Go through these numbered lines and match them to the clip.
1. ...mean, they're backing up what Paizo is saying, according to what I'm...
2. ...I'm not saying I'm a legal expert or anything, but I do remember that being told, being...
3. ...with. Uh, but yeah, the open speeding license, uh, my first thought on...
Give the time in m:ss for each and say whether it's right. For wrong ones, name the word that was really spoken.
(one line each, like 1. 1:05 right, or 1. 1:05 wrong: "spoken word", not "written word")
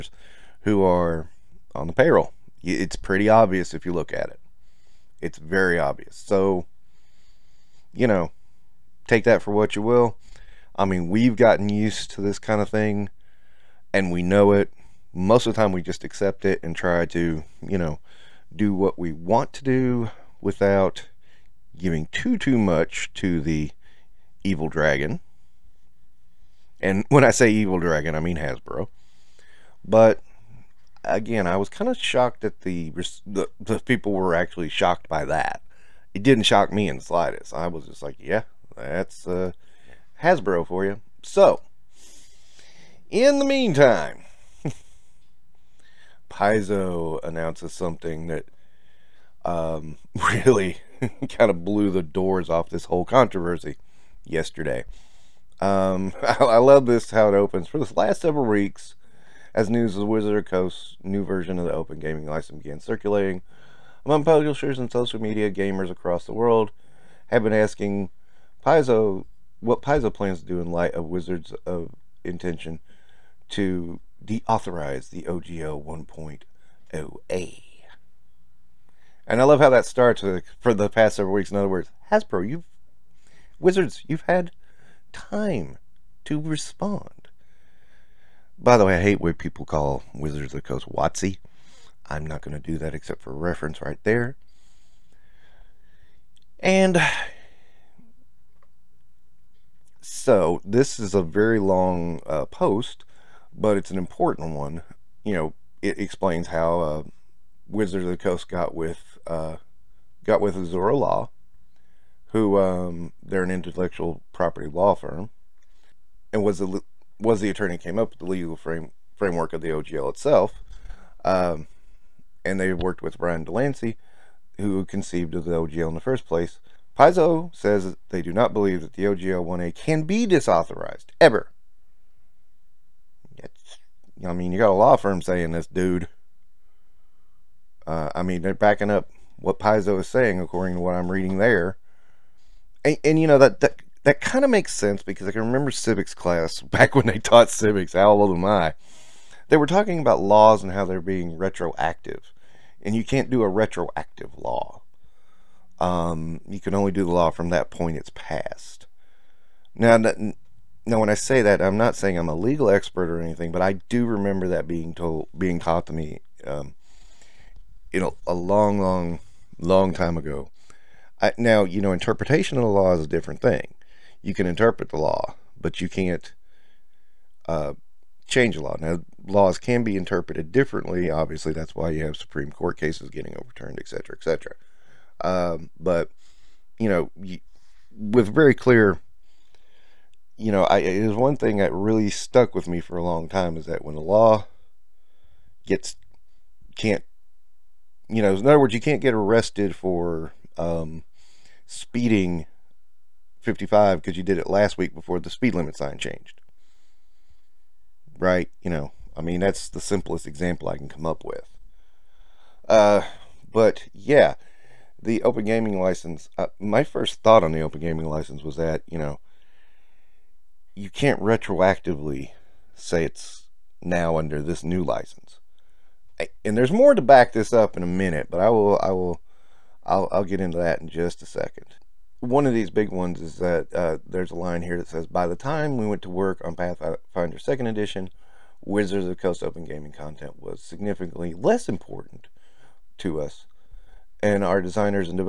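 1. 2:18 right
2. 2:41 right
3. 3:31 wrong: "gaming", not "speeding".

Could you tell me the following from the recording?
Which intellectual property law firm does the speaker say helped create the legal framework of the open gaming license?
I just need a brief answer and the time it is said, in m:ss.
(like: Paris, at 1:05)
Azora Law, at 1:50.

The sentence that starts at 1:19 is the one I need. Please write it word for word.
And I love how that starts for the past several weeks.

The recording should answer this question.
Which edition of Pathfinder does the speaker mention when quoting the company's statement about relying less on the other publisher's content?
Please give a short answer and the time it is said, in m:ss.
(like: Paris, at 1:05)
2nd Edition, at 3:57.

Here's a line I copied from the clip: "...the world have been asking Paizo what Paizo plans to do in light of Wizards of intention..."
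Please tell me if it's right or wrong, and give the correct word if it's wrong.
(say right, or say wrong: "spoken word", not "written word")
right.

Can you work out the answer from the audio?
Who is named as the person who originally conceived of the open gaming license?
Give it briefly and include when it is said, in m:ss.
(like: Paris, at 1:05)
Brian Delancey, at 2:03.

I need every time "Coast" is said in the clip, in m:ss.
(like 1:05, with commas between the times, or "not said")
1:00, 1:30, 1:48, 3:59.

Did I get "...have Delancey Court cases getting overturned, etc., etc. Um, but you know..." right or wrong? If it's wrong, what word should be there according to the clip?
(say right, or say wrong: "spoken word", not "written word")
wrong: "Supreme", not "Delancey".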